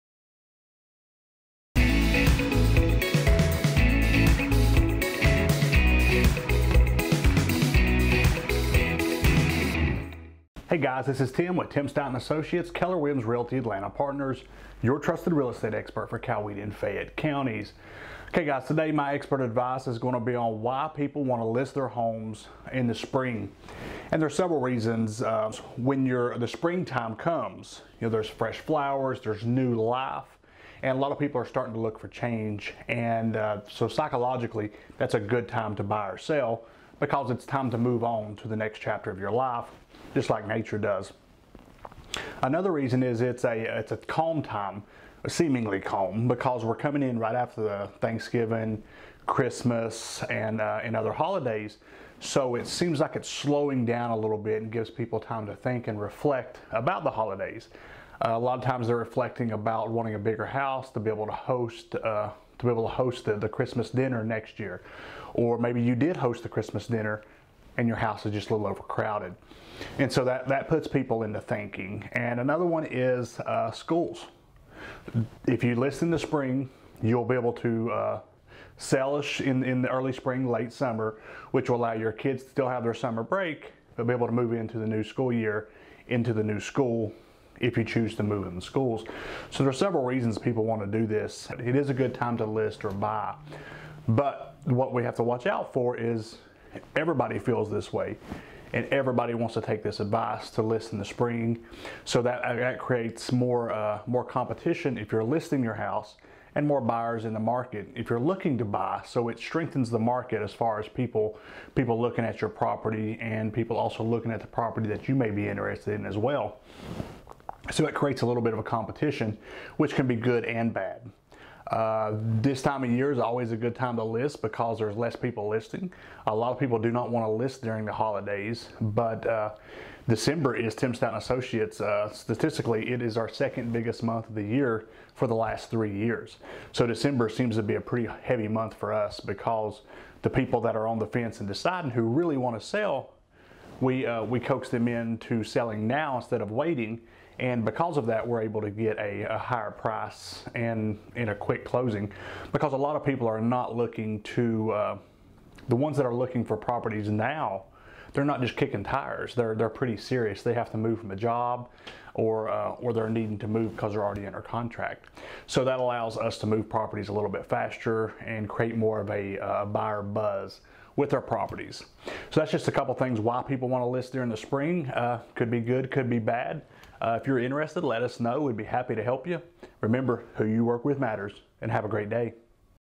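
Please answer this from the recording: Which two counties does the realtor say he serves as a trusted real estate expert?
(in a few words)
Coweta and Fayette.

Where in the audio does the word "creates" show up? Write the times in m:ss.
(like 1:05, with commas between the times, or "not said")
1:42, 1:57, 2:48.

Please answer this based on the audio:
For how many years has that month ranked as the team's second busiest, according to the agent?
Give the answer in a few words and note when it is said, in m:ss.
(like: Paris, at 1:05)
3, at 2:15.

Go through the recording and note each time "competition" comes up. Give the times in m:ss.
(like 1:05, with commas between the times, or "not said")
1:44, 1:58.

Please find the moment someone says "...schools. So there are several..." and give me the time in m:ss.
1:28.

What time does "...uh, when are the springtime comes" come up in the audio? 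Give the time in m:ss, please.
0:25.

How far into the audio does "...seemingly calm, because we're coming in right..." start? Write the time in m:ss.
0:45.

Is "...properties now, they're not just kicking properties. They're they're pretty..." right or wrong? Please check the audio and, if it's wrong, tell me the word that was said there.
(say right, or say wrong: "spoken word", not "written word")
wrong: "tires", not "properties".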